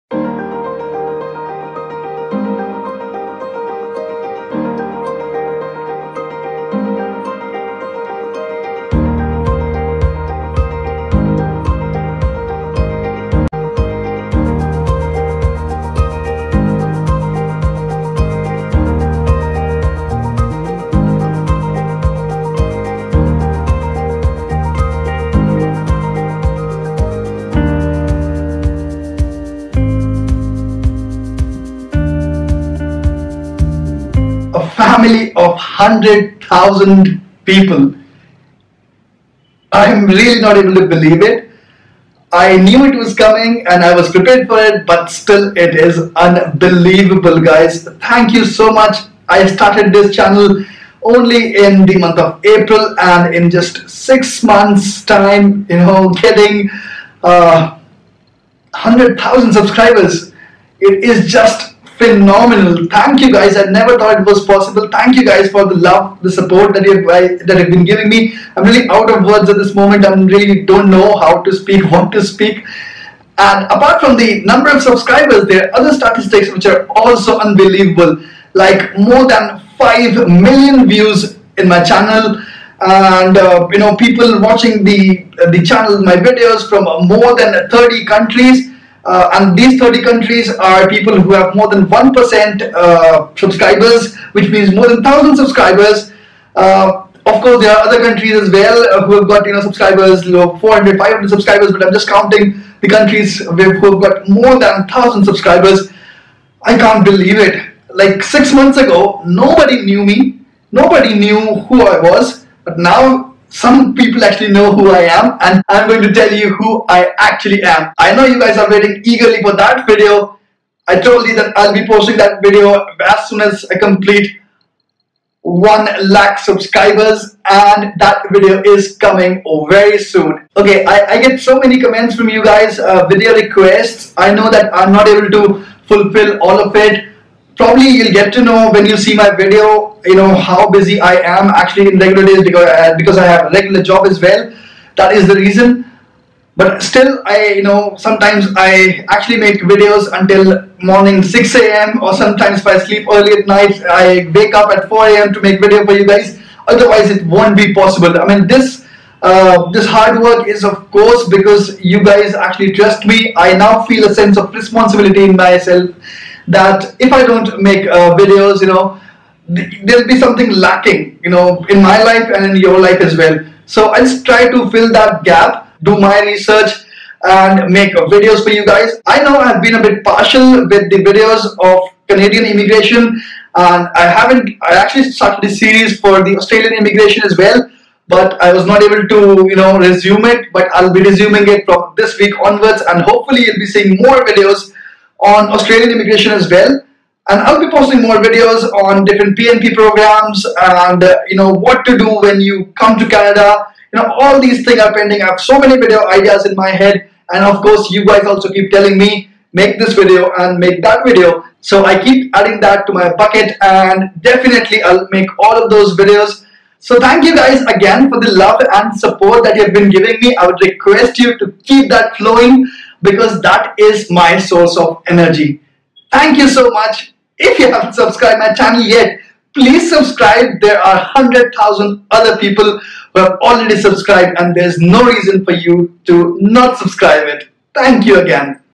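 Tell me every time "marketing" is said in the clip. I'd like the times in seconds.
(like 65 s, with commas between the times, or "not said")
not said.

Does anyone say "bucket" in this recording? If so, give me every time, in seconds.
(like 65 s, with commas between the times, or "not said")
213 s.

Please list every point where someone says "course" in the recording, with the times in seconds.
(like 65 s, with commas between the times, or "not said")
97 s, 160 s, 207 s.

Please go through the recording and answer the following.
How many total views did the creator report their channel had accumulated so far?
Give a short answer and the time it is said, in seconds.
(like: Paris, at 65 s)
More than 5 million, at 78 s.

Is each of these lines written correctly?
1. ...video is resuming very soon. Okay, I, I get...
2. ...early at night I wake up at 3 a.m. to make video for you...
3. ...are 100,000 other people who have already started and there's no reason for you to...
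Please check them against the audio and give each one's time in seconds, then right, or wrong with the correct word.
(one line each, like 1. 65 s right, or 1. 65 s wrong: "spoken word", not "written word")
1. 128 s wrong: "coming", not "resuming"
2. 153 s wrong: "4", not "3"
3. 230 s wrong: "subscribed", not "started".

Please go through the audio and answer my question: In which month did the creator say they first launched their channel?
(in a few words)
April.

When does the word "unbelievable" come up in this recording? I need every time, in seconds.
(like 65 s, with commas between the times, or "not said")
46 s, 77 s.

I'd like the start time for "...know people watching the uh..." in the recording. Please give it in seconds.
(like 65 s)
83 s.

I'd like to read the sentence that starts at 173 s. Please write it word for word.
So I just try to fill that gap, do my research, and make videos for you guys.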